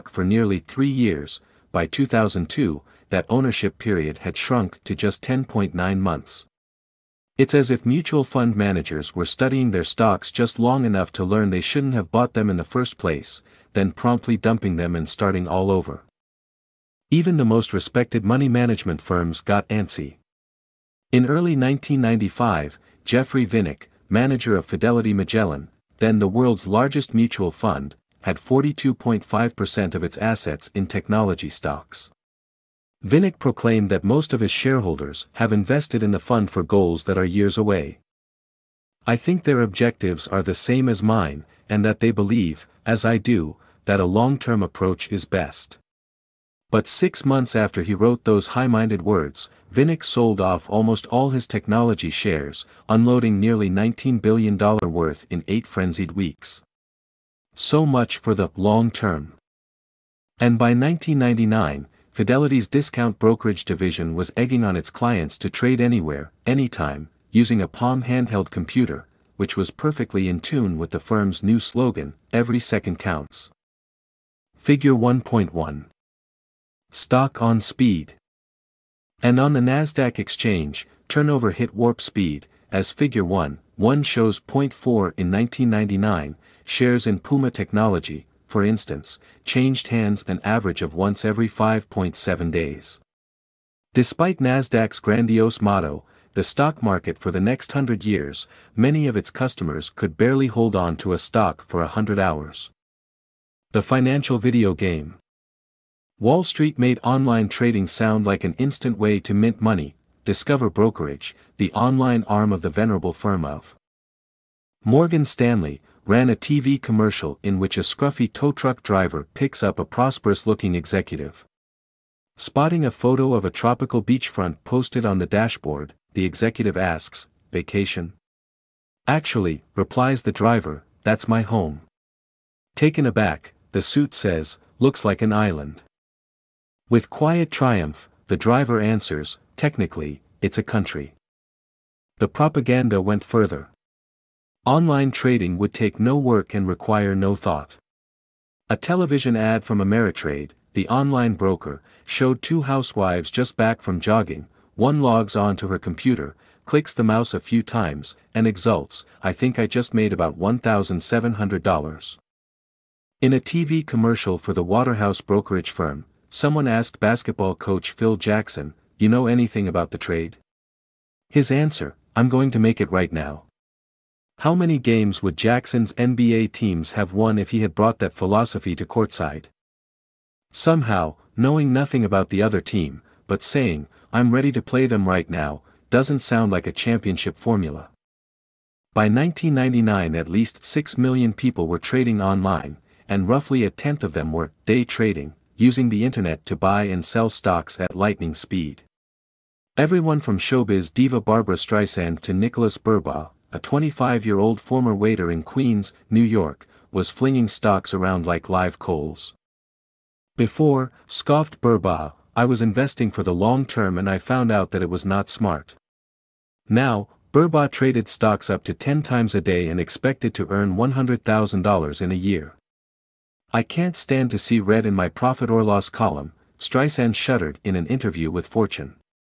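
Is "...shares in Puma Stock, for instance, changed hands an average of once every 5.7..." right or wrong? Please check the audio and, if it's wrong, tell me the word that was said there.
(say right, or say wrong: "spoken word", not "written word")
wrong: "Technology", not "Stock".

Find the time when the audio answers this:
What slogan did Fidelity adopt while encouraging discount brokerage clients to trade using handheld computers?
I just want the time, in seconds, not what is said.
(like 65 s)
72 s.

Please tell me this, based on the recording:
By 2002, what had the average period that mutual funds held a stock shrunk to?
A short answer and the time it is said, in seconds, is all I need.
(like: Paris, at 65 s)
10.9 months, at 5 s.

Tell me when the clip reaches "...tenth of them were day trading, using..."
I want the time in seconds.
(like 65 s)
193 s.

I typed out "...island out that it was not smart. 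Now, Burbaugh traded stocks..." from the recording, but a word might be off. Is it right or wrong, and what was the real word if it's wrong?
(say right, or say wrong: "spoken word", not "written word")
wrong: "found", not "island".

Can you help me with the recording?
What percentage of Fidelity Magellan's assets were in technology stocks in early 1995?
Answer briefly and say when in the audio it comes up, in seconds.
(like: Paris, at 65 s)
42.5%, at 28 s.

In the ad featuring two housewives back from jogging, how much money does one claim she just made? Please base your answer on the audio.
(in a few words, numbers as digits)
$1,700.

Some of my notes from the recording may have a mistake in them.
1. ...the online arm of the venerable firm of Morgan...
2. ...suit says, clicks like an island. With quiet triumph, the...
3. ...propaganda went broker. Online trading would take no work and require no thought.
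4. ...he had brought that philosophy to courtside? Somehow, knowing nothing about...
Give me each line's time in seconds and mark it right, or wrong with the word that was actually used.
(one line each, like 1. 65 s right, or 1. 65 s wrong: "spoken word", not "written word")
1. 111 s right
2. 133 s wrong: "looks", not "clicks"
3. 142 s wrong: "further", not "broker"
4. 177 s right.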